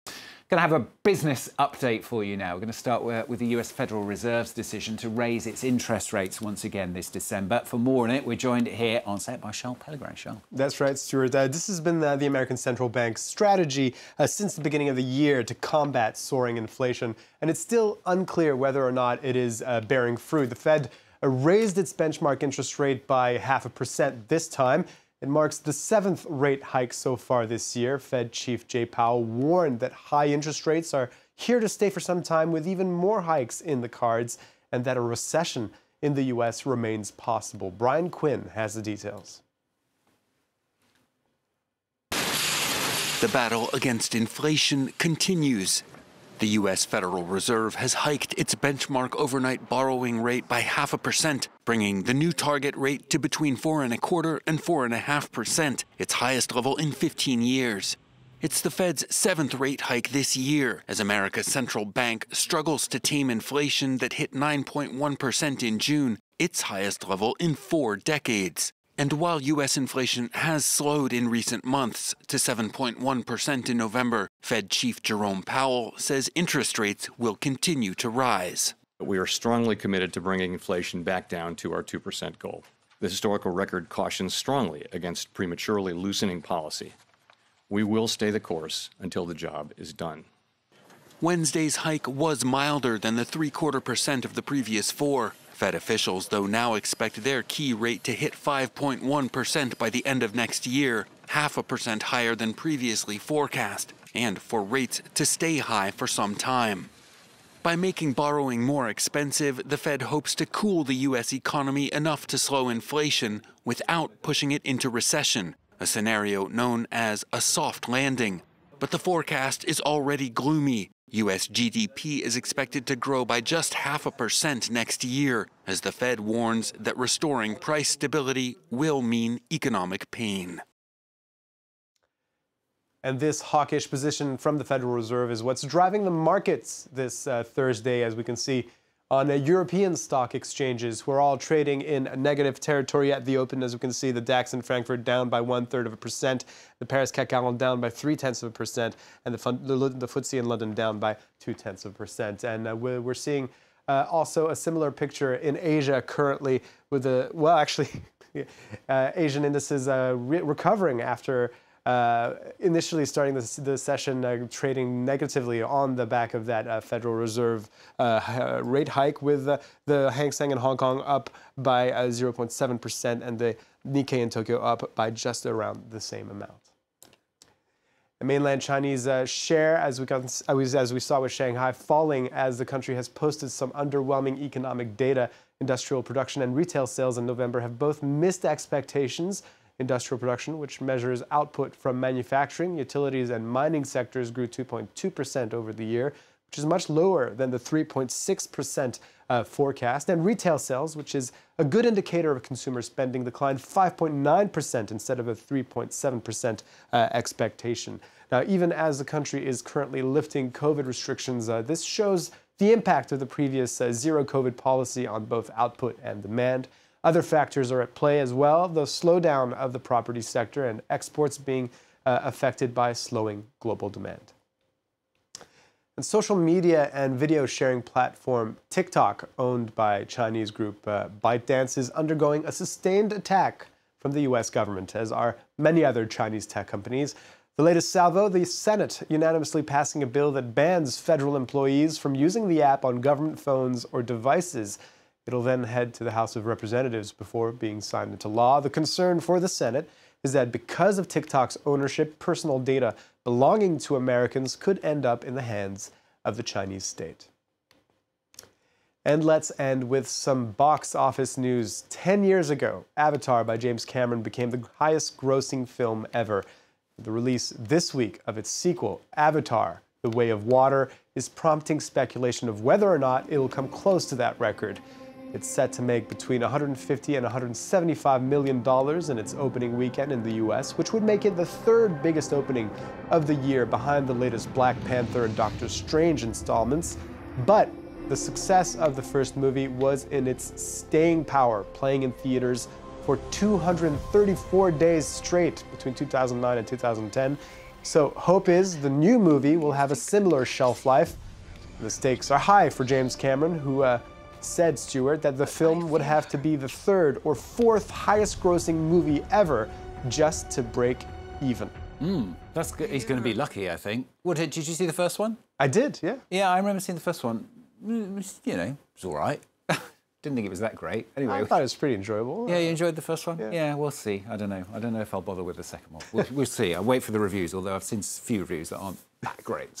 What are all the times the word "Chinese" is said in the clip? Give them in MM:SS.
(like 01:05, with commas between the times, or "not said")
02:58, 03:50, 03:56, 04:16.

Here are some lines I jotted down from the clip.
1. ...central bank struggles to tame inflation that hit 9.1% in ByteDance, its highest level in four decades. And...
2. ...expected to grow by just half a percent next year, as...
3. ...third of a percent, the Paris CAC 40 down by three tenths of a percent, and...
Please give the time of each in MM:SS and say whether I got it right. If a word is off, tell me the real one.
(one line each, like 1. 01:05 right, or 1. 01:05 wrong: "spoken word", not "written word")
1. 01:01 wrong: "June", not "ByteDance"
2. 02:02 right
3. 02:25 right.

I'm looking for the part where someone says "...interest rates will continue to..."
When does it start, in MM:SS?
01:16.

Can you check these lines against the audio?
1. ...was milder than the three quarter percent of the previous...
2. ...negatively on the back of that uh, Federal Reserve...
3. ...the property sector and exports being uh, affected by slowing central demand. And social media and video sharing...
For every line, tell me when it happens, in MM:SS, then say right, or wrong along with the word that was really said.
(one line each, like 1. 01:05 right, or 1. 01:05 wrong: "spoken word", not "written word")
1. 01:32 right
2. 02:45 right
3. 03:39 wrong: "global", not "central".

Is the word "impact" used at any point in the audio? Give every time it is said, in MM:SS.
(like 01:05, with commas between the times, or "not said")
03:32.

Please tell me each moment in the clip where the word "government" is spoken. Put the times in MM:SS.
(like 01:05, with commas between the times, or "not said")
03:54, 04:03.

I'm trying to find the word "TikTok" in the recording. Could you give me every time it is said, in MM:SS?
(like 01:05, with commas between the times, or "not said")
03:48, 04:11.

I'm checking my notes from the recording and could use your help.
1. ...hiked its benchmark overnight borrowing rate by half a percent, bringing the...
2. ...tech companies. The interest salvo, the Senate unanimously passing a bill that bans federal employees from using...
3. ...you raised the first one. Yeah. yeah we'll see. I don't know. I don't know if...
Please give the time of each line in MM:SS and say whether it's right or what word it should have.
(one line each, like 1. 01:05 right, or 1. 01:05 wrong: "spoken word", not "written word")
1. 00:47 right
2. 03:56 wrong: "latest", not "interest"
3. 05:22 wrong: "enjoyed", not "raised".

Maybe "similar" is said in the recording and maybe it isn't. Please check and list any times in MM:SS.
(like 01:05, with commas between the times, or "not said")
02:34, 04:59.